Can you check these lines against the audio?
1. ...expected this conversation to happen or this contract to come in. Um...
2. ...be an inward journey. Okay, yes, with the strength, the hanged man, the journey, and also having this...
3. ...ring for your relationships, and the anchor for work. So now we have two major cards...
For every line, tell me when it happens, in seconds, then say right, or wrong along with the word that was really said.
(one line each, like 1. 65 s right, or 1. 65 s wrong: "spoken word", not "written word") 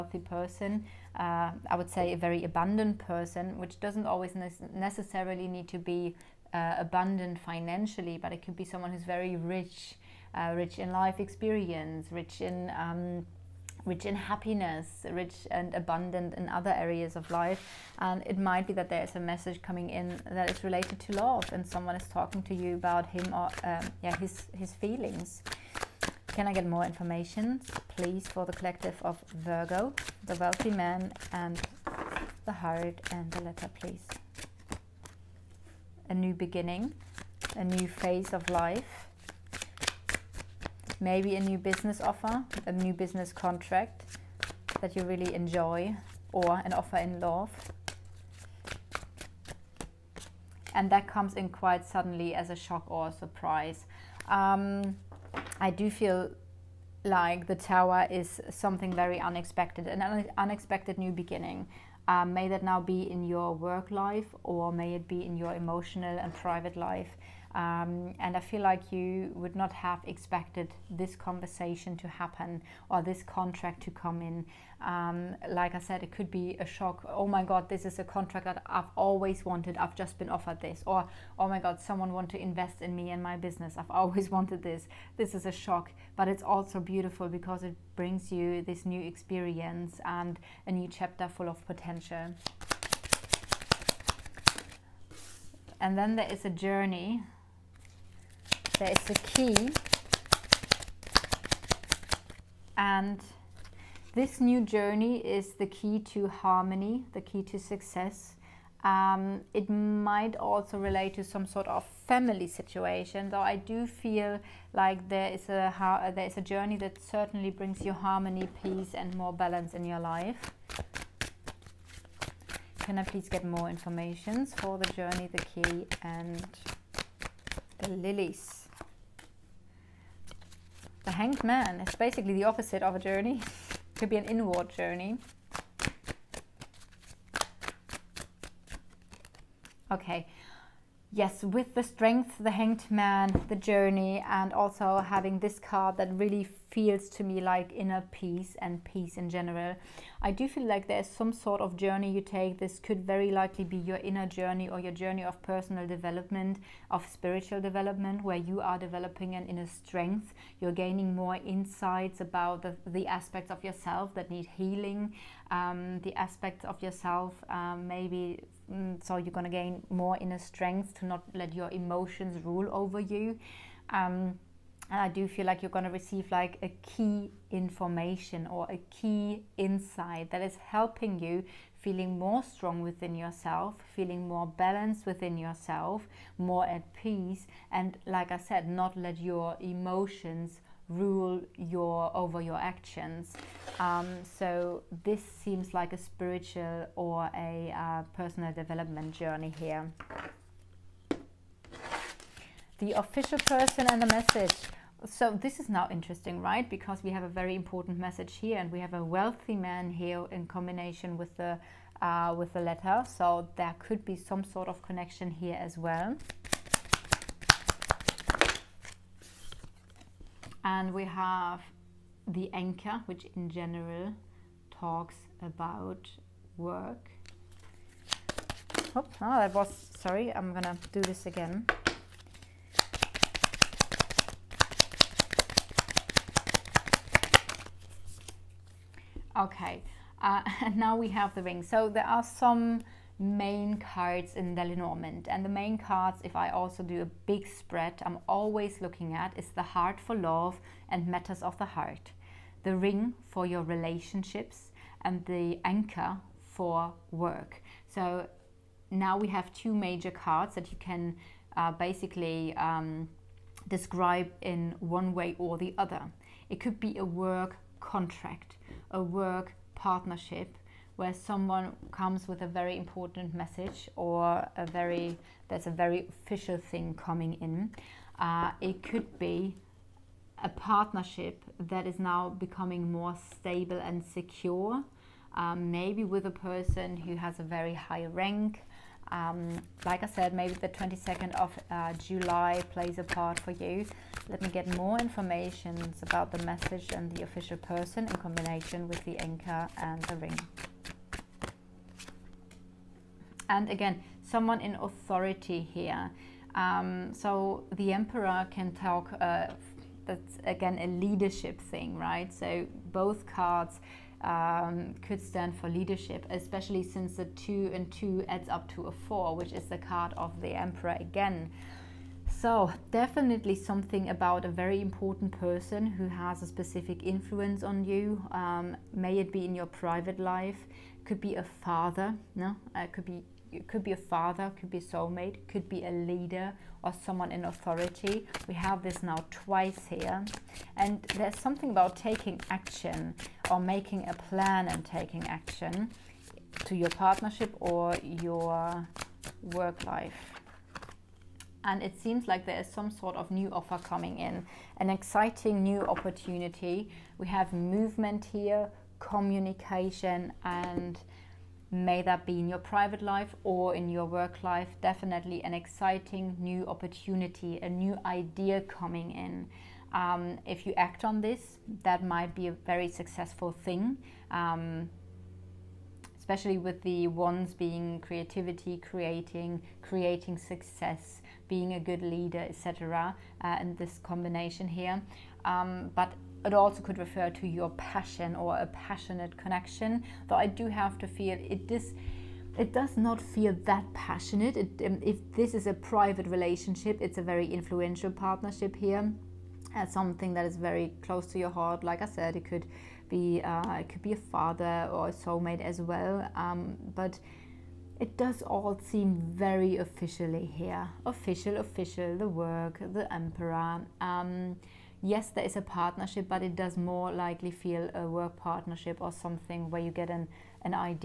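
1. 70 s right
2. 134 s right
3. 252 s right.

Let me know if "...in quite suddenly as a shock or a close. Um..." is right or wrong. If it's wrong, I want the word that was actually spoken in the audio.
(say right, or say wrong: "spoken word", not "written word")
wrong: "surprise", not "close".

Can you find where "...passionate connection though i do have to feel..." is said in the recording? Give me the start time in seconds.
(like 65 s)
388 s.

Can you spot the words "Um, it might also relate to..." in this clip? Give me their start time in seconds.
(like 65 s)
108 s.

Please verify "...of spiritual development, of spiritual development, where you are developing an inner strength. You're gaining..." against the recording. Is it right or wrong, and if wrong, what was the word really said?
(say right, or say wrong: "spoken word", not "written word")
wrong: "personal", not "spiritual".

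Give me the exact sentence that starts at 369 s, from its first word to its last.
Um, if you act on this, that might be a very successful thing.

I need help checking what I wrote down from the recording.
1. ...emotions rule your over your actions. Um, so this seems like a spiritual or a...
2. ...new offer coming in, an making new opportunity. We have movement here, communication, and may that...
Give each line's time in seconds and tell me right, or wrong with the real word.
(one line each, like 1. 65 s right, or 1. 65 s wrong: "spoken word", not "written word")
1. 189 s right
2. 353 s wrong: "exciting", not "making".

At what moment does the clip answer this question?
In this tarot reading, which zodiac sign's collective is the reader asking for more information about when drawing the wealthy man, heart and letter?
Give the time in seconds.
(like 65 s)
29 s.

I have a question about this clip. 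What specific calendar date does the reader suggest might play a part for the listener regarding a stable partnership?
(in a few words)
22nd of July.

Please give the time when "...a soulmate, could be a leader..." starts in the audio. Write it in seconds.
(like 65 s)
334 s.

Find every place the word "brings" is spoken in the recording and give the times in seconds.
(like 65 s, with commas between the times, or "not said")
87 s, 117 s.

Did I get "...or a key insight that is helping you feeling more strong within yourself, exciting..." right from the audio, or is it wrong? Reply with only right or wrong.
wrong.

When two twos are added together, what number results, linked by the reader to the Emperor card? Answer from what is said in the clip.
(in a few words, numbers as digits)
4.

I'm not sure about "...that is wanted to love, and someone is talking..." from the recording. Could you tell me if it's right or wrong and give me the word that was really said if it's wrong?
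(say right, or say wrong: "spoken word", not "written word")
wrong: "related", not "wanted".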